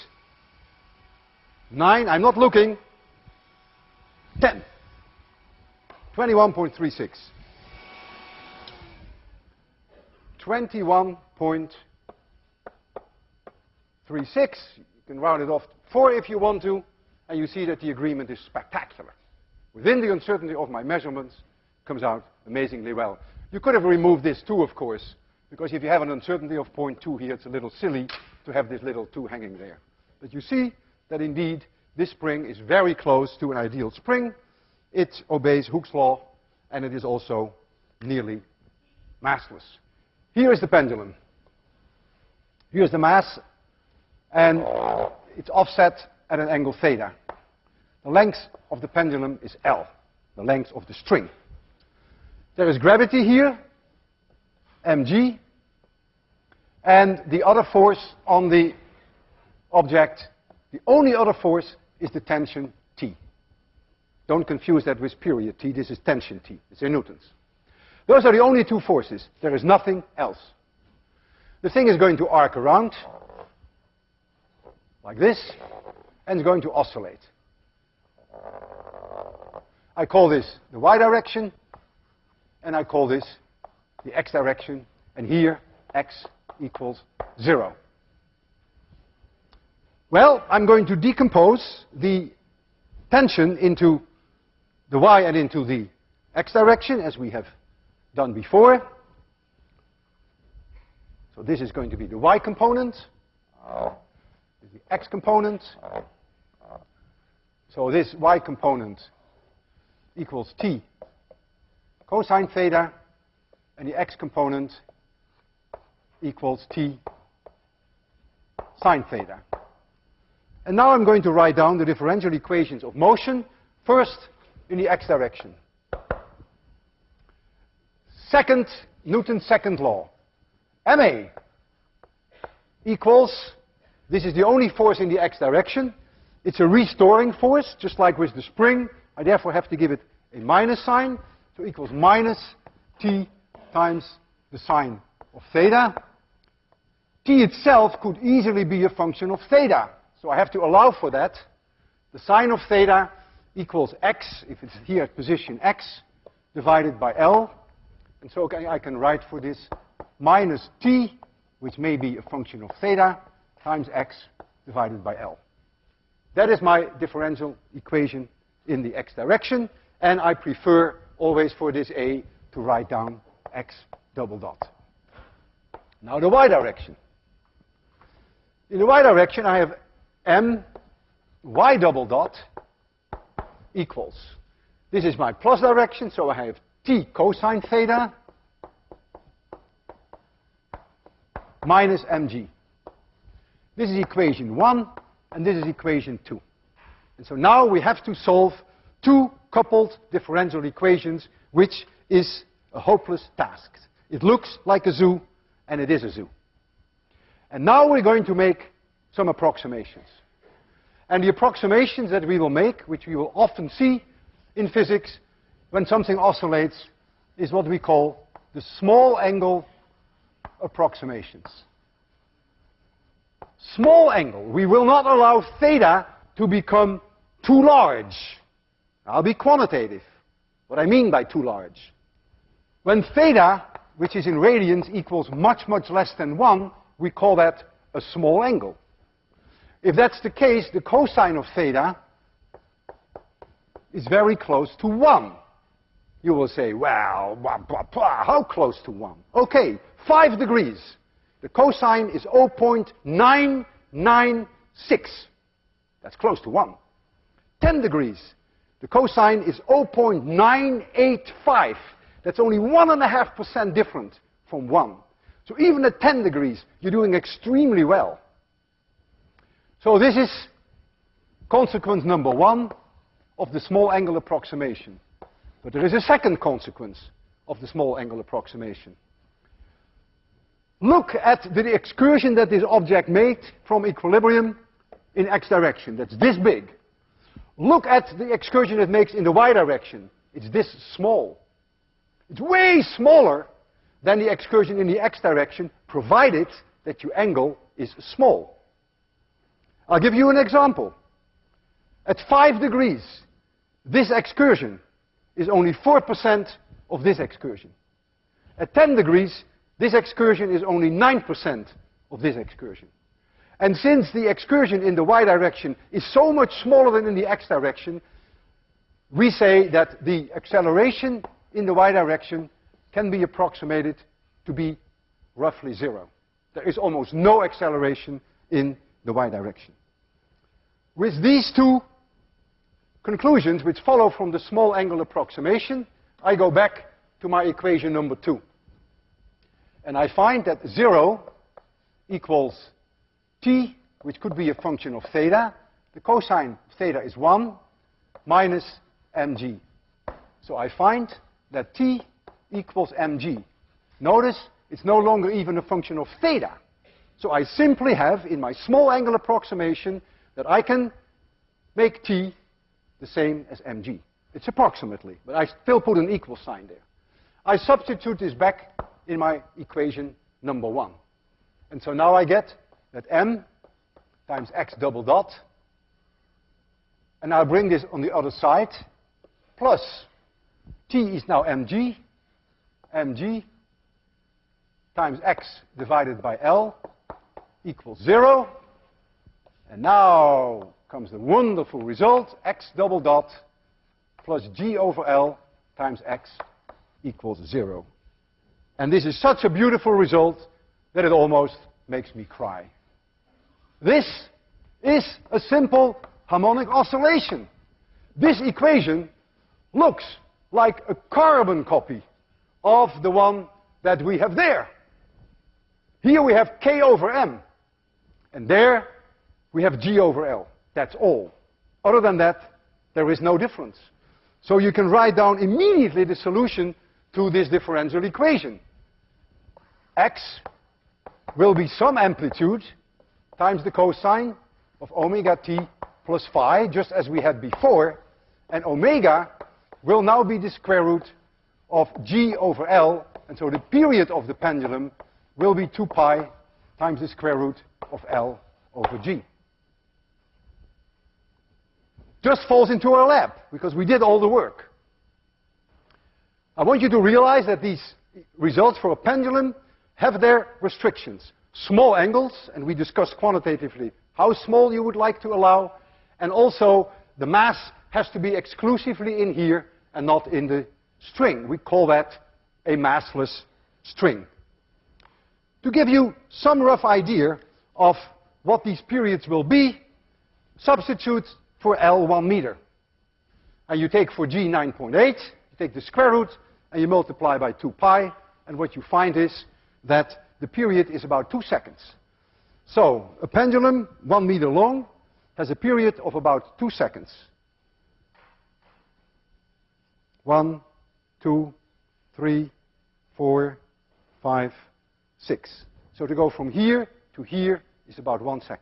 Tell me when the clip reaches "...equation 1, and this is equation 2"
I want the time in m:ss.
3:13.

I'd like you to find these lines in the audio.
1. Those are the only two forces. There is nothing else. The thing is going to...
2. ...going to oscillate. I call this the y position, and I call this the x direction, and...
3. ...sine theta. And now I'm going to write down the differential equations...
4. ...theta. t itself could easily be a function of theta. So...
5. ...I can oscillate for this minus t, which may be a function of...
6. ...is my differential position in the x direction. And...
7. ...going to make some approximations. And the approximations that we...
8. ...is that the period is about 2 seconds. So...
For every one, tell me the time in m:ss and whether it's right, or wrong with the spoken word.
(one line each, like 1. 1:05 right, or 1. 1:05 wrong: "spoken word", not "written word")
1. 1:08 right
2. 1:16 wrong: "direction", not "position"
3. 1:58 right
4. 2:25 right
5. 2:38 wrong: "write", not "oscillate"
6. 2:46 wrong: "equation", not "position"
7. 3:28 right
8. 8:09 right.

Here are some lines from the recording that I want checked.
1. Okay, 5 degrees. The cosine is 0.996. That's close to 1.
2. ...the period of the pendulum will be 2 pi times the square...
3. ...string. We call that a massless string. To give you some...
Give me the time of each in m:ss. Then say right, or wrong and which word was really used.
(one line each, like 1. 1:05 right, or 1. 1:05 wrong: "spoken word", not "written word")
1. 4:09 right
2. 7:23 right
3. 7:51 right.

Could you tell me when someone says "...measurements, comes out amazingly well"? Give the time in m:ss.
0:20.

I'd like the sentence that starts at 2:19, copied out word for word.
I therefore have to give it a minus sign.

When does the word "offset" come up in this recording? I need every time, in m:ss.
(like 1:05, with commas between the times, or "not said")
0:45.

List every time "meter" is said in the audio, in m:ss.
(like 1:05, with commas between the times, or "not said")
8:02, 8:14.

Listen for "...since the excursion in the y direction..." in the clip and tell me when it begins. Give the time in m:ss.
5:13.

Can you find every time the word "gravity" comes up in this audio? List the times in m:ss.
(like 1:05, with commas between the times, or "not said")
0:52.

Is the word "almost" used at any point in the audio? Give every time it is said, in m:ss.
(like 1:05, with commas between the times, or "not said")
5:26, 6:41.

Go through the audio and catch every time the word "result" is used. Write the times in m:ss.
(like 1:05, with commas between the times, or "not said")
6:31, 6:39, 7:38.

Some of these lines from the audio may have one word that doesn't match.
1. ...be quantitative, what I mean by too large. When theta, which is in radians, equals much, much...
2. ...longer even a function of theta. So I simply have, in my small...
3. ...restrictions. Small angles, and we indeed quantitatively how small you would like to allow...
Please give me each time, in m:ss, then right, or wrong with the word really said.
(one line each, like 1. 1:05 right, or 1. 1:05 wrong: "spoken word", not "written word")
1. 3:49 right
2. 5:54 right
3. 7:40 wrong: "discussed", not "indeed".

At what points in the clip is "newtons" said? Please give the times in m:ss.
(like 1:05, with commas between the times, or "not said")
1:06, 2:09.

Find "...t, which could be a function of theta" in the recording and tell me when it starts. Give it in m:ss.
5:43.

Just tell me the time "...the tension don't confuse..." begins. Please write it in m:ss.
1:02.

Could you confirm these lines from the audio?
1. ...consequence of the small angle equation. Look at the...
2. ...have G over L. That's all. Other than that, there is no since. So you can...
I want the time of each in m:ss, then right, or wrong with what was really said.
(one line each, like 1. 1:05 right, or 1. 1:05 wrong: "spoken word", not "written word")
1. 4:36 wrong: "approximation", not "equation"
2. 6:59 wrong: "difference", not "since".